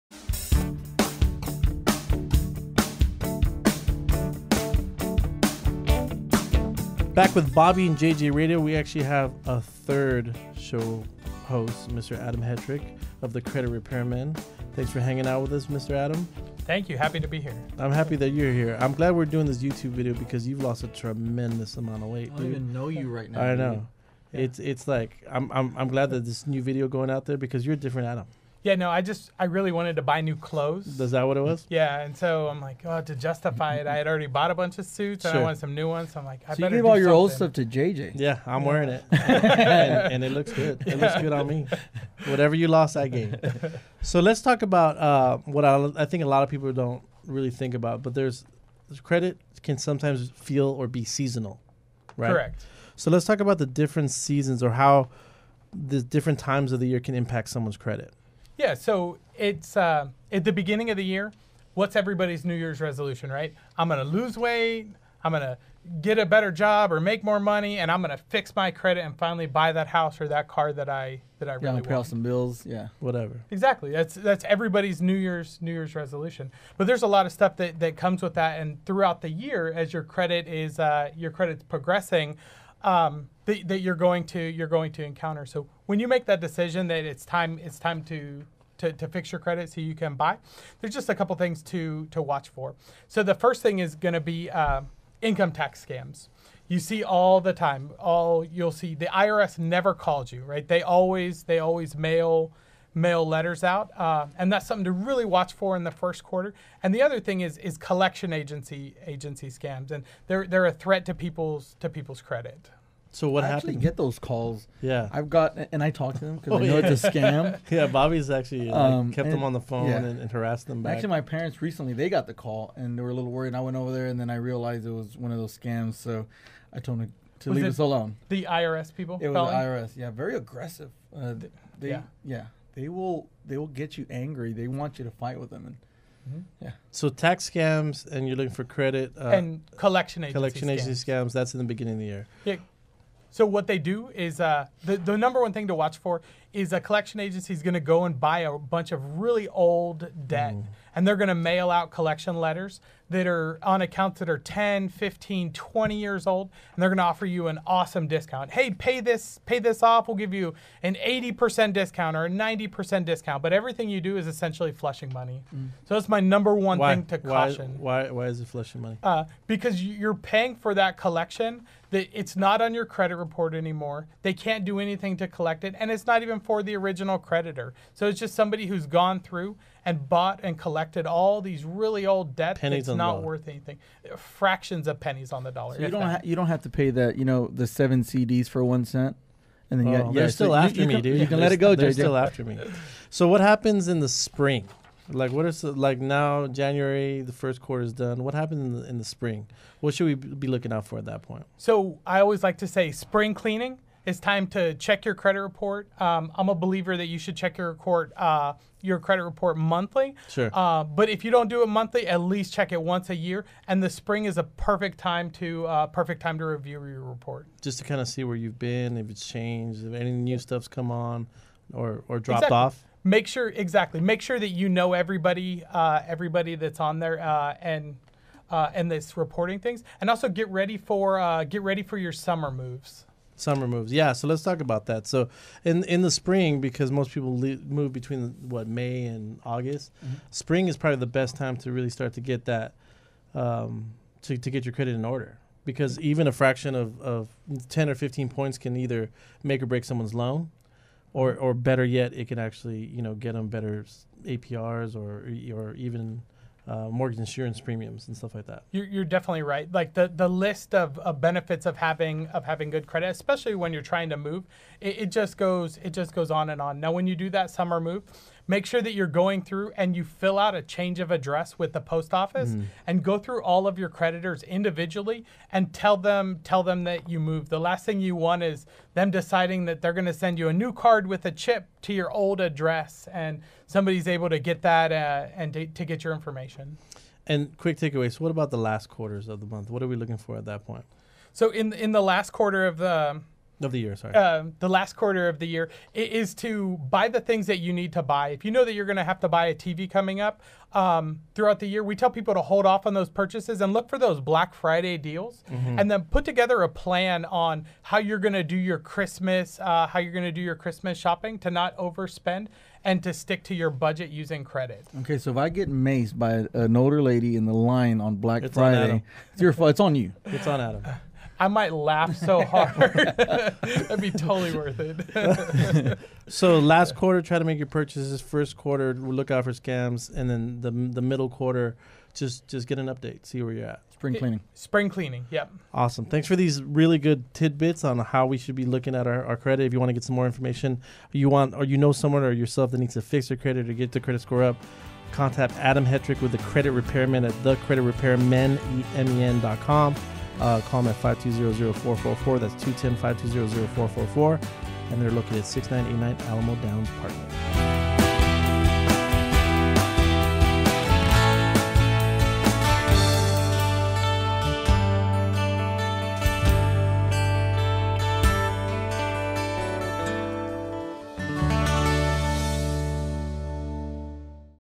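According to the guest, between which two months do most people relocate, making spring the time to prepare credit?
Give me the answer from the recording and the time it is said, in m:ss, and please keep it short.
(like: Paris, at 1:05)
May and August, at 3:58.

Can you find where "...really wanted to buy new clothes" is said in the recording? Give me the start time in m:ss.
0:29.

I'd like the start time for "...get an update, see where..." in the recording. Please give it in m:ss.
5:32.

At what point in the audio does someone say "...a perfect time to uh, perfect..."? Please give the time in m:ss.
3:34.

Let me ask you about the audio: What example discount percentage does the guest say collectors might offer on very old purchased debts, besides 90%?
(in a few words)
80%.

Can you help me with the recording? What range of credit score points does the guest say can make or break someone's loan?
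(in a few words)
10 to 15 points.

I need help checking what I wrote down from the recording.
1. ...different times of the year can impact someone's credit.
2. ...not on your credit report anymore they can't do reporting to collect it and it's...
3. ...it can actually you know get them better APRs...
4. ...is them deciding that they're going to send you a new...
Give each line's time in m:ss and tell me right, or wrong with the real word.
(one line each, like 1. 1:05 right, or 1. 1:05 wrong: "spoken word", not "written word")
1. 0:56 right
2. 2:52 wrong: "anything", not "reporting"
3. 4:12 right
4. 4:38 right.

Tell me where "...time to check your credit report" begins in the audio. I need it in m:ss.
3:24.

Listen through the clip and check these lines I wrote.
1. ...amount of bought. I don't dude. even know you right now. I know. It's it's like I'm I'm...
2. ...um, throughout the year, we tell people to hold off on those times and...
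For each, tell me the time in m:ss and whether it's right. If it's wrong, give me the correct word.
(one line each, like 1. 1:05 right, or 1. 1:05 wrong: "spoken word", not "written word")
1. 0:21 wrong: "weight", not "bought"
2. 5:00 wrong: "purchases", not "times".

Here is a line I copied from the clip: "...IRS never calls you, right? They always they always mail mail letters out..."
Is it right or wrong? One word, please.
right.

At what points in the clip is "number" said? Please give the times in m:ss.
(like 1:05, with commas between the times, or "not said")
2:25, 2:46.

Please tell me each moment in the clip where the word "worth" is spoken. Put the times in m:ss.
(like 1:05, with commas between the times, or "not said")
3:03, 5:24.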